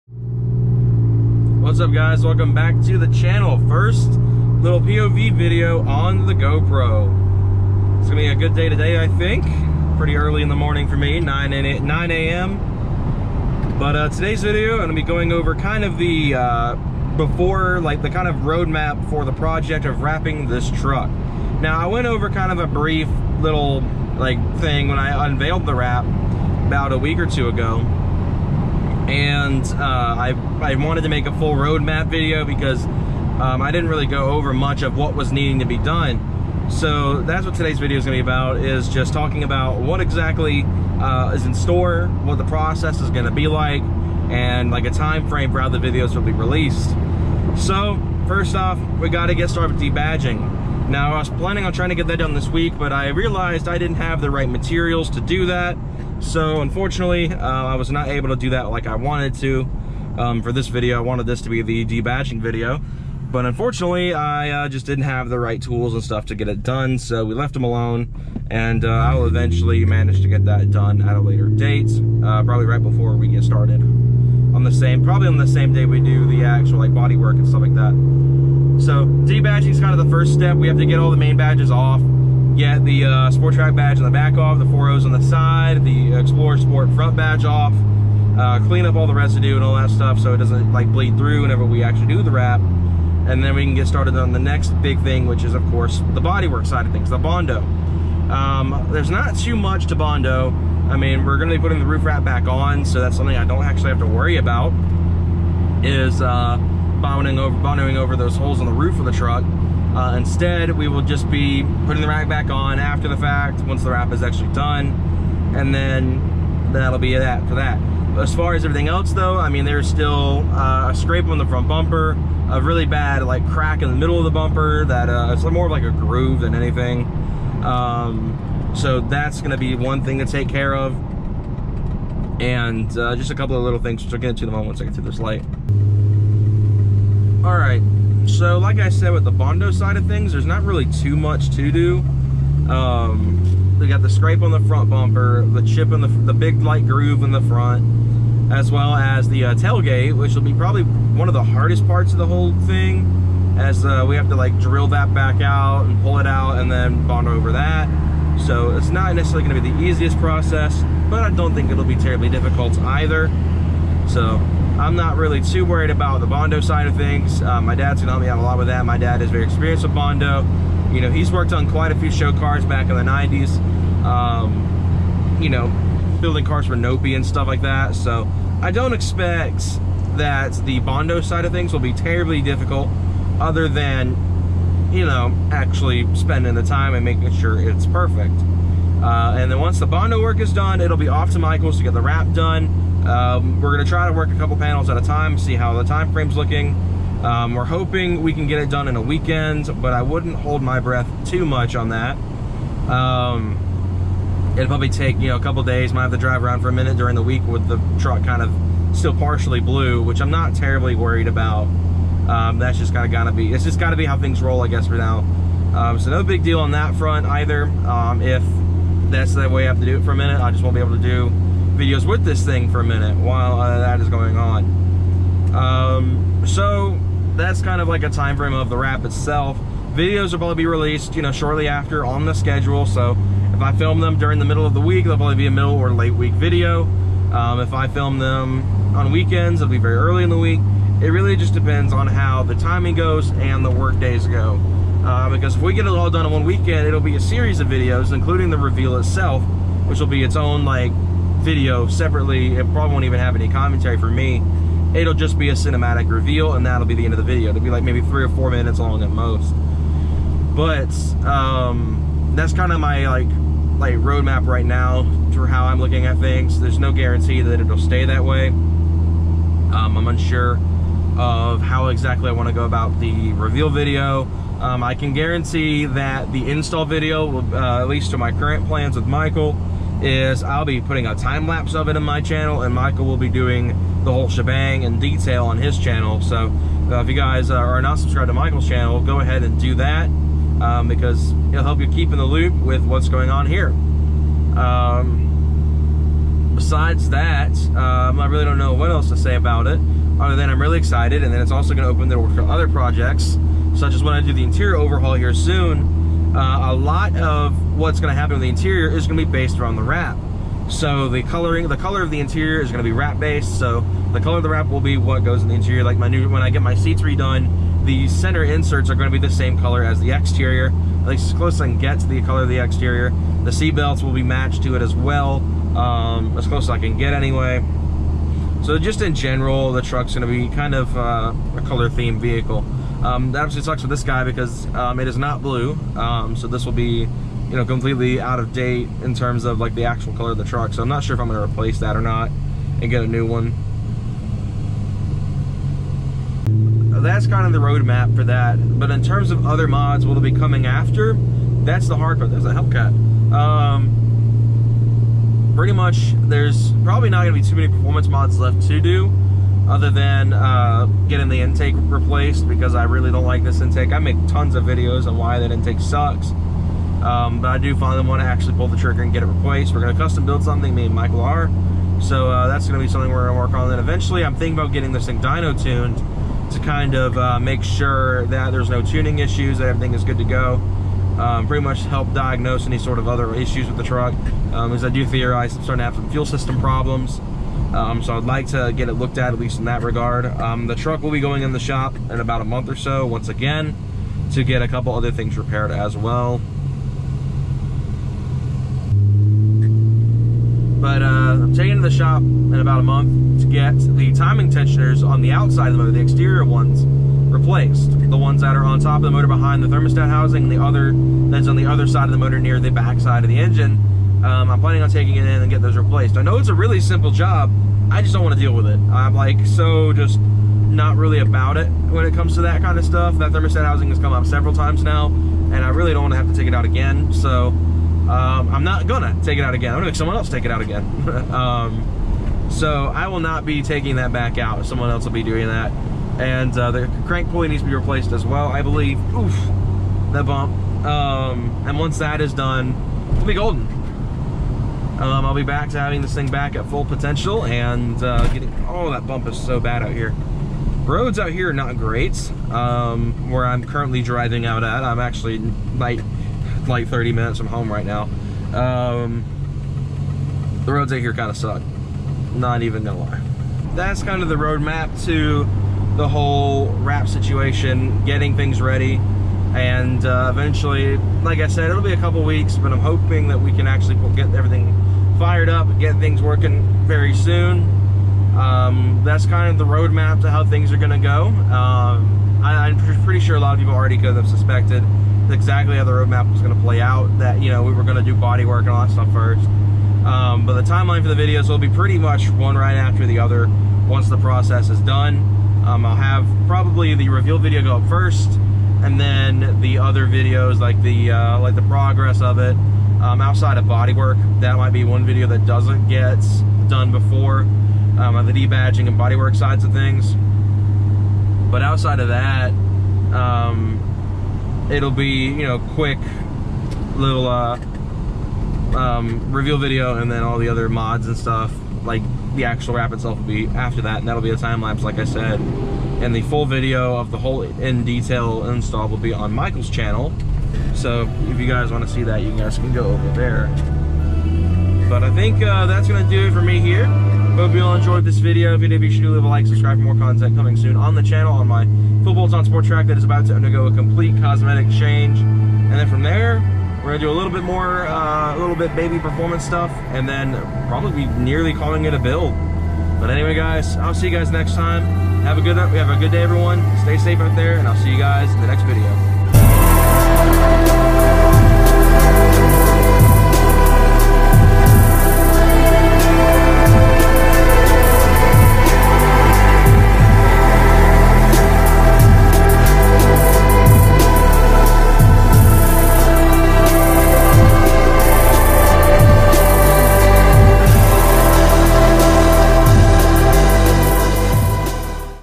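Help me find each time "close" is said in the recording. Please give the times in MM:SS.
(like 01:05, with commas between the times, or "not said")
05:21, 05:26.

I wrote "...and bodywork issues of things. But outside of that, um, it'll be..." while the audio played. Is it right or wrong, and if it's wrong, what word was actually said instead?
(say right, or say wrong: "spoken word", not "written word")
wrong: "sides", not "issues".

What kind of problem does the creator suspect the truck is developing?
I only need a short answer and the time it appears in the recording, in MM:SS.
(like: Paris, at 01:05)
Fuel system problems, at 06:26.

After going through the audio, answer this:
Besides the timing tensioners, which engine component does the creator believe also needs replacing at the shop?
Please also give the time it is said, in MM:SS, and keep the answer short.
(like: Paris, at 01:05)
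Crank pulley, at 07:17.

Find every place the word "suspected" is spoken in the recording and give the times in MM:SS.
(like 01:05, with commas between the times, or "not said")
08:04.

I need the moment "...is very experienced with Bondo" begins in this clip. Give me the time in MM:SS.
02:49.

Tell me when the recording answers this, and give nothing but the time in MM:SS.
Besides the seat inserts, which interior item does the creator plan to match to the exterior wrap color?
05:23.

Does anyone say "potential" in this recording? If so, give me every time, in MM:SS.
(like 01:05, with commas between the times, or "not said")
07:26.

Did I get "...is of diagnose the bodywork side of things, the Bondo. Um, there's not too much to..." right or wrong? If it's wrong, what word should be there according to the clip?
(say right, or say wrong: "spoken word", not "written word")
wrong: "course", not "diagnose".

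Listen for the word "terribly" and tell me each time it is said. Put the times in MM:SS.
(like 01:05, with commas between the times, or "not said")
02:41, 03:01, 03:30.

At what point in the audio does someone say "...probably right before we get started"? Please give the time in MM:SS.
01:12.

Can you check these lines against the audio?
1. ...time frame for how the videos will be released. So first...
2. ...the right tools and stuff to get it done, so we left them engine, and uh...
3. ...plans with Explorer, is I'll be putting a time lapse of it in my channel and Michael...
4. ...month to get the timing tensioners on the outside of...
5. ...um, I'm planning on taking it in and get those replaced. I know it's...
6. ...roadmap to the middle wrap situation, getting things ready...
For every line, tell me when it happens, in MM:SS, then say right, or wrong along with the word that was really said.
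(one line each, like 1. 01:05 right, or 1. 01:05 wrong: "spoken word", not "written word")
1. 00:44 right
2. 01:05 wrong: "alone", not "engine"
3. 04:38 wrong: "Michael", not "Explorer"
4. 06:42 right
5. 06:54 right
6. 07:44 wrong: "whole", not "middle".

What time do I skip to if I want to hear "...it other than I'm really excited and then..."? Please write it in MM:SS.
04:59.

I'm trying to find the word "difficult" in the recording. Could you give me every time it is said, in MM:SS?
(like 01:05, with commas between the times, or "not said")
02:42, 03:02.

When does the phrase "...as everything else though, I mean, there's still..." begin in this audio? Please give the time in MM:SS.
01:58.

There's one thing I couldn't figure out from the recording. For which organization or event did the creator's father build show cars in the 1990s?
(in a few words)
Nopi.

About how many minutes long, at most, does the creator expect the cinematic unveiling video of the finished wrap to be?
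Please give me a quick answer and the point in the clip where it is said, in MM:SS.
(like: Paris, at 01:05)
4 minutes, at 04:18.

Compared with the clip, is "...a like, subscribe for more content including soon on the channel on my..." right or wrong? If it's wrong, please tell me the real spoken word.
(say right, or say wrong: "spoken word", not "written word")
wrong: "coming", not "including".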